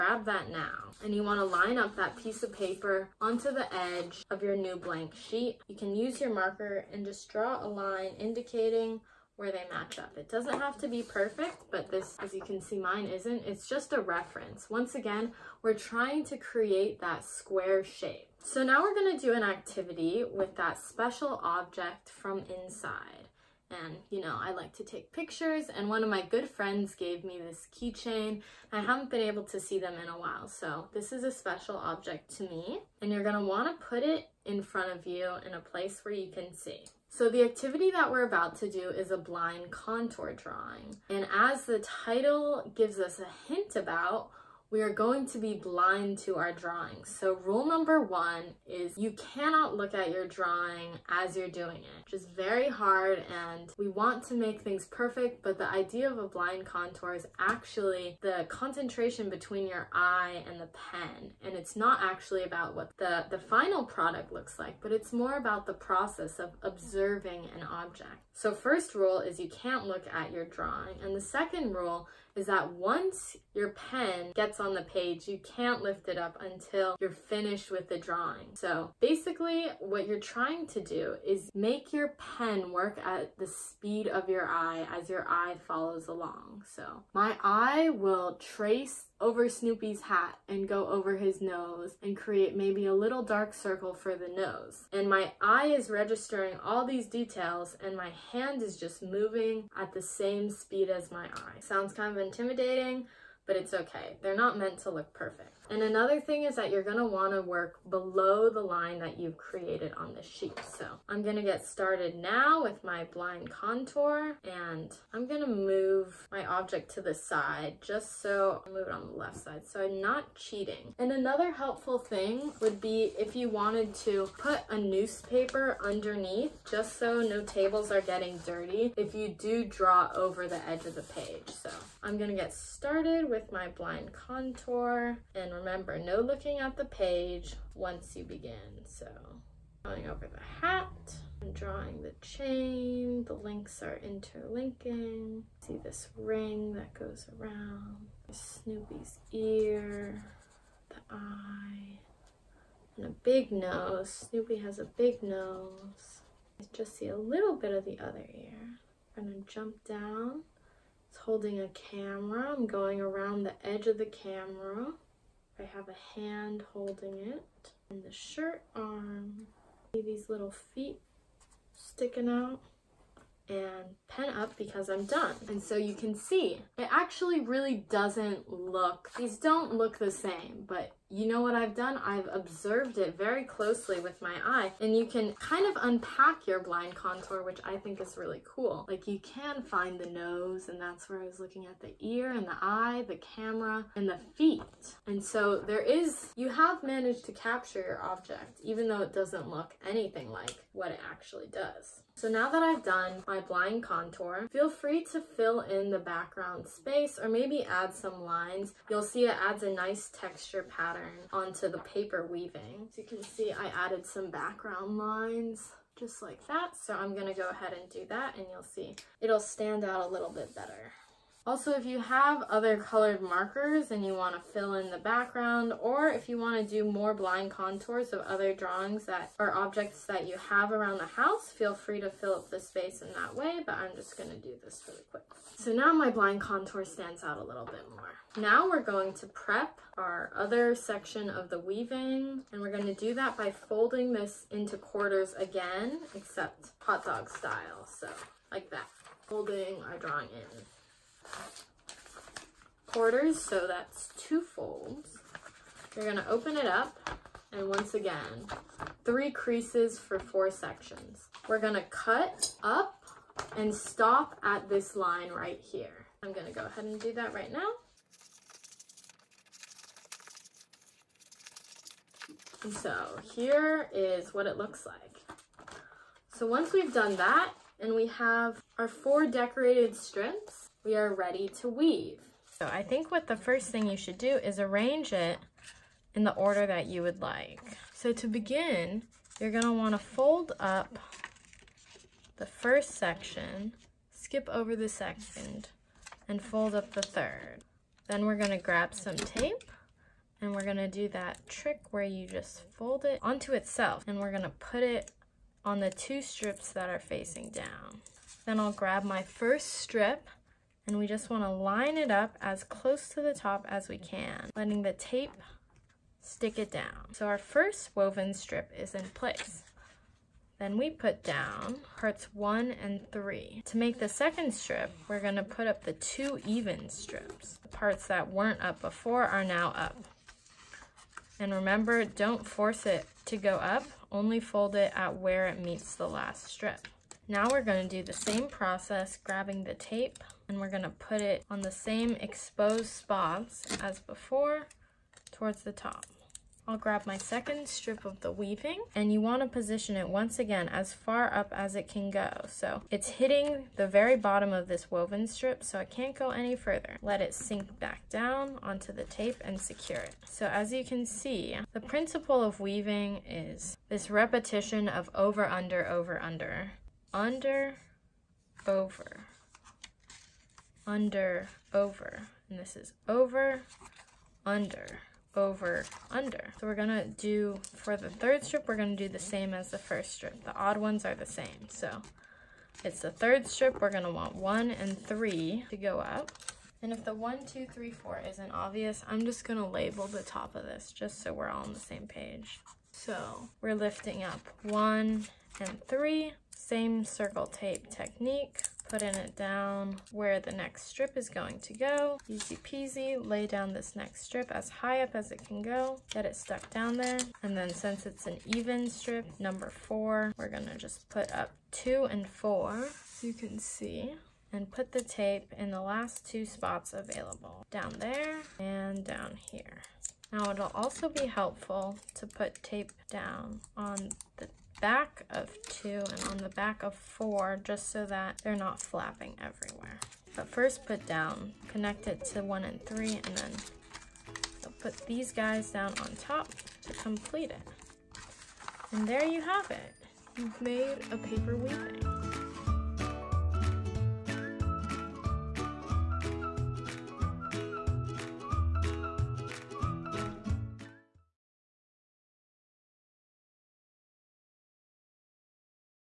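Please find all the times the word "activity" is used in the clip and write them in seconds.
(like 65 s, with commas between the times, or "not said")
19 s, 37 s.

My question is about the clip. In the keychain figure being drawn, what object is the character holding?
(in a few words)
a camera.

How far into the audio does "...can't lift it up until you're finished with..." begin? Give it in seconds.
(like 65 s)
75 s.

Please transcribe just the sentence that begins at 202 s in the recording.
So now that I've done my blind contour, feel free to fill in the background space or maybe add some lines.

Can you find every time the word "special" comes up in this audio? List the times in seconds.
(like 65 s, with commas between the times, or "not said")
20 s, 31 s.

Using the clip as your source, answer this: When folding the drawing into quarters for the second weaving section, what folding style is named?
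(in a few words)
hot dog style.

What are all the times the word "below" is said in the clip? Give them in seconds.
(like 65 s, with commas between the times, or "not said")
107 s.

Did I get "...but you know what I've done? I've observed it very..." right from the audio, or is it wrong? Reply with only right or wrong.
right.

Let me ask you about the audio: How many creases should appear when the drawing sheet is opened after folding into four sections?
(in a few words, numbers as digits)
3.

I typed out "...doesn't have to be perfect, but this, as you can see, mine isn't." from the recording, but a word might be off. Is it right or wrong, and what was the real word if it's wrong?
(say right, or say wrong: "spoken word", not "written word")
right.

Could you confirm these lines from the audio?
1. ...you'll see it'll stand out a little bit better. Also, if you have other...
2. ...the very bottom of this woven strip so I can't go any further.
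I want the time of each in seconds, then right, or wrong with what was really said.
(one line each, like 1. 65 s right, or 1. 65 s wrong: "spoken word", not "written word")
1. 218 s right
2. 353 s right.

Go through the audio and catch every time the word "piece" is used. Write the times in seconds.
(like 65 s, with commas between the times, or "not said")
2 s.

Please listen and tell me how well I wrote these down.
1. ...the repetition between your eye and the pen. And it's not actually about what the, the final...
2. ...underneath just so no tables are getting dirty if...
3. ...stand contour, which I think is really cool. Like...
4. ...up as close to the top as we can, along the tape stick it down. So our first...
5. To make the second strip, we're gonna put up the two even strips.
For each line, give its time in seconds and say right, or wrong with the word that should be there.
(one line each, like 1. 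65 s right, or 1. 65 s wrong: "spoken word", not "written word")
1. 58 s wrong: "concentration", not "repetition"
2. 125 s right
3. 186 s wrong: "blind", not "stand"
4. 312 s wrong: "letting", not "along"
5. 323 s right.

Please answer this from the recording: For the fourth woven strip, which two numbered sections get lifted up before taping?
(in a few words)
2 and 4.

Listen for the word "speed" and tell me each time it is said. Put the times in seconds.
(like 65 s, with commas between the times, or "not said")
83 s, 100 s.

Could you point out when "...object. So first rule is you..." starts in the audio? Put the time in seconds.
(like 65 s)
67 s.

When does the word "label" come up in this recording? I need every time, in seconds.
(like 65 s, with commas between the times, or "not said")
389 s.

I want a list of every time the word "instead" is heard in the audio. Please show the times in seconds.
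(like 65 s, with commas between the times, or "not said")
not said.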